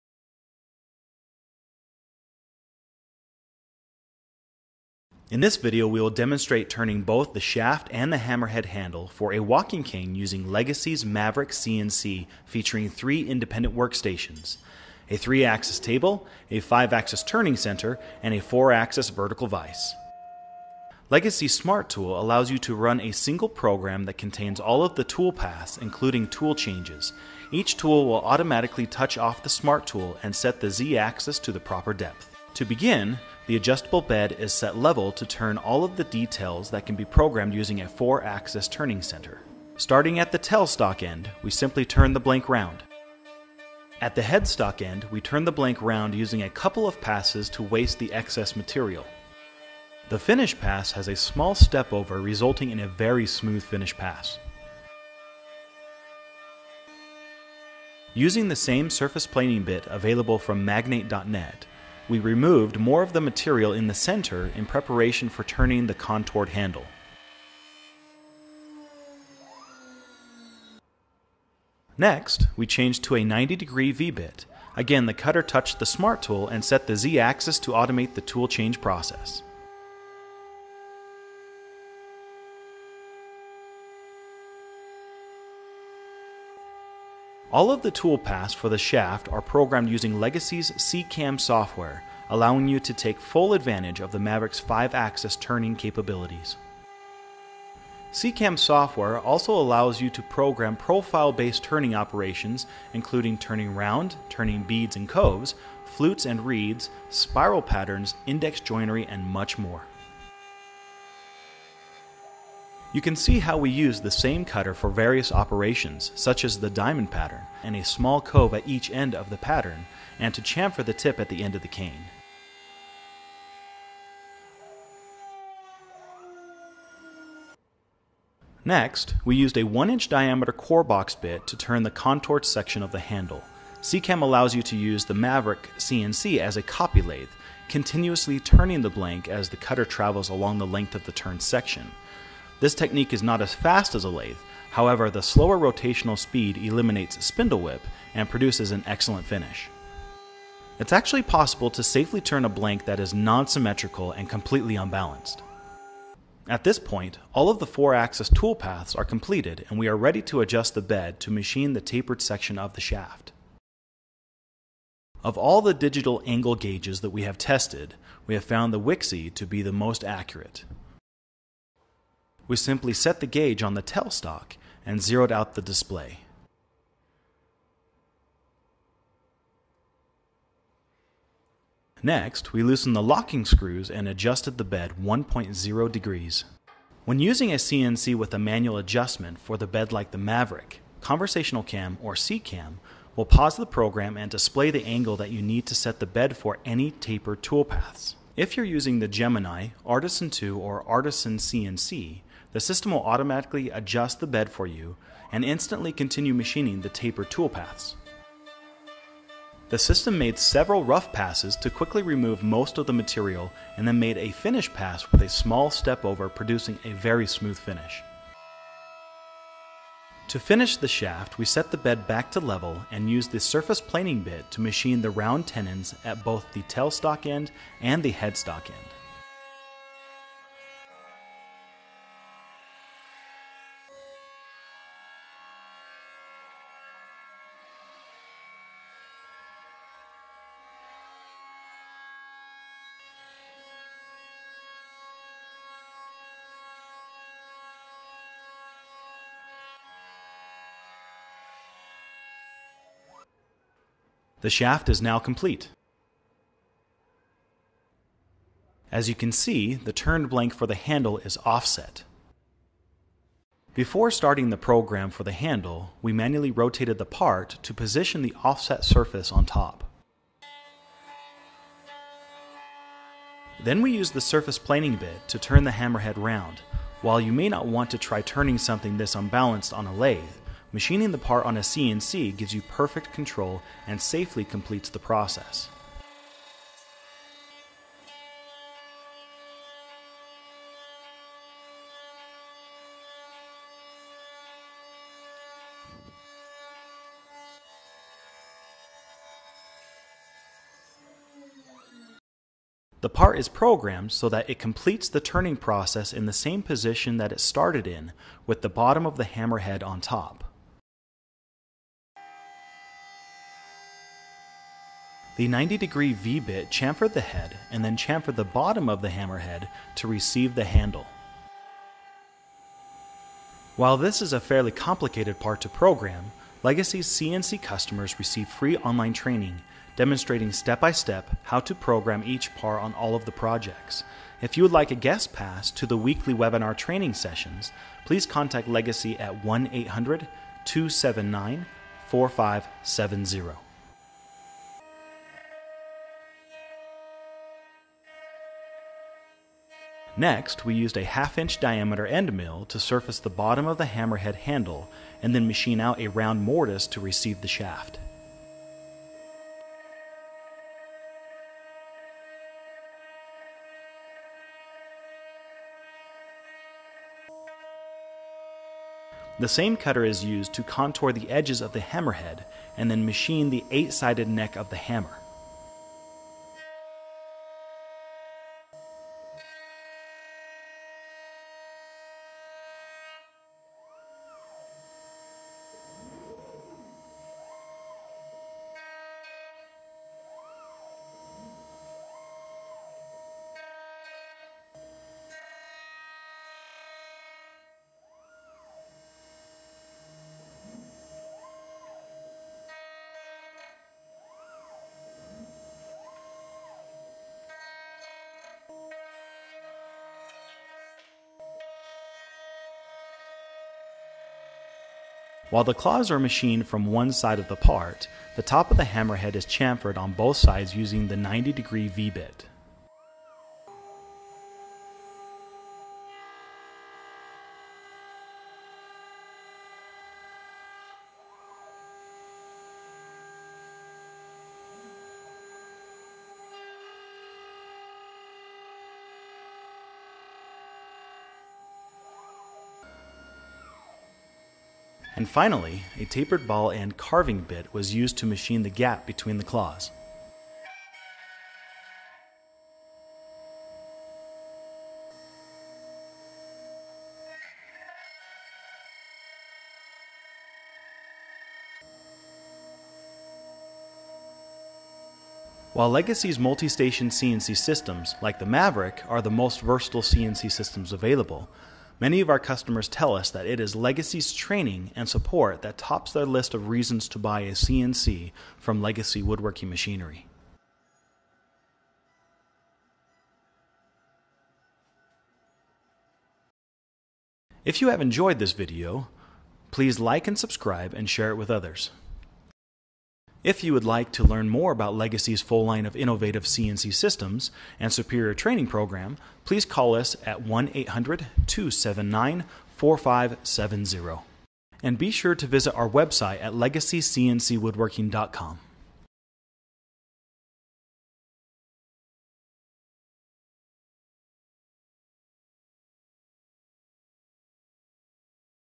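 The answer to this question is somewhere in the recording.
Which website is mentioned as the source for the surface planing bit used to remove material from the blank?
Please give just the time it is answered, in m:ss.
1:00.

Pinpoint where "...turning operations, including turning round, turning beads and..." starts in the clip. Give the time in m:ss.
1:41.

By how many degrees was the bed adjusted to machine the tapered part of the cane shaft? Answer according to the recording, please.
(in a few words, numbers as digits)
1.0 degrees.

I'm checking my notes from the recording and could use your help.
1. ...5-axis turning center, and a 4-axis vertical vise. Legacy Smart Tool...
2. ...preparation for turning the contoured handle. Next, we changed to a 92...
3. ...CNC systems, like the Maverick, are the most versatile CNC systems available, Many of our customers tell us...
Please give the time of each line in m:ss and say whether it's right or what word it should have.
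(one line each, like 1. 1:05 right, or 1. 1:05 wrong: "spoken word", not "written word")
1. 0:16 right
2. 1:04 wrong: "90", not "92"
3. 7:47 right.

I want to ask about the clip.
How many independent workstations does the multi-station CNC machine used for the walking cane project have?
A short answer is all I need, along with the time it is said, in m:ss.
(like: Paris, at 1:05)
3, at 0:12.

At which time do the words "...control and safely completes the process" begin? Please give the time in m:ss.
4:43.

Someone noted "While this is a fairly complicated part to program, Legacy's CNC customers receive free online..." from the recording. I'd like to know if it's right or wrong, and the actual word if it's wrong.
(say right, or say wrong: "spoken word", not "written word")
right.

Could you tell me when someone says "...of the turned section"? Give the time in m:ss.
2:20.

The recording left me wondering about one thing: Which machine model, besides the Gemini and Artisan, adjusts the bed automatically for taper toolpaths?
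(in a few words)
Artisan 2.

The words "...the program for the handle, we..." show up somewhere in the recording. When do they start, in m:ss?
4:24.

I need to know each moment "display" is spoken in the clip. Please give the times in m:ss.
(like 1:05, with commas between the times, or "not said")
2:55, 3:14.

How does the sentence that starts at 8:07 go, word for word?
If you have enjoyed this video, please like and subscribe and share it with others.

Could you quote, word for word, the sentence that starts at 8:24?
And be sure to visit our website at legacycncwoodworking.com.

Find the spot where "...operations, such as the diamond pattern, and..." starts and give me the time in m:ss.
1:55.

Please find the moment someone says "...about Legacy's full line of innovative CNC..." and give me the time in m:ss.
8:14.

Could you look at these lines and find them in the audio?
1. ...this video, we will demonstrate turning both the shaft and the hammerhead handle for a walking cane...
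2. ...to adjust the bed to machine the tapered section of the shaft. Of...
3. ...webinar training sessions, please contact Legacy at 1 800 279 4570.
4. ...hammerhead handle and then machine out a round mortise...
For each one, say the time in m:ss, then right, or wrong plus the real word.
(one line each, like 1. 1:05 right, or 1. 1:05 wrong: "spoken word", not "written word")
1. 0:05 right
2. 2:40 right
3. 5:36 right
4. 5:53 right.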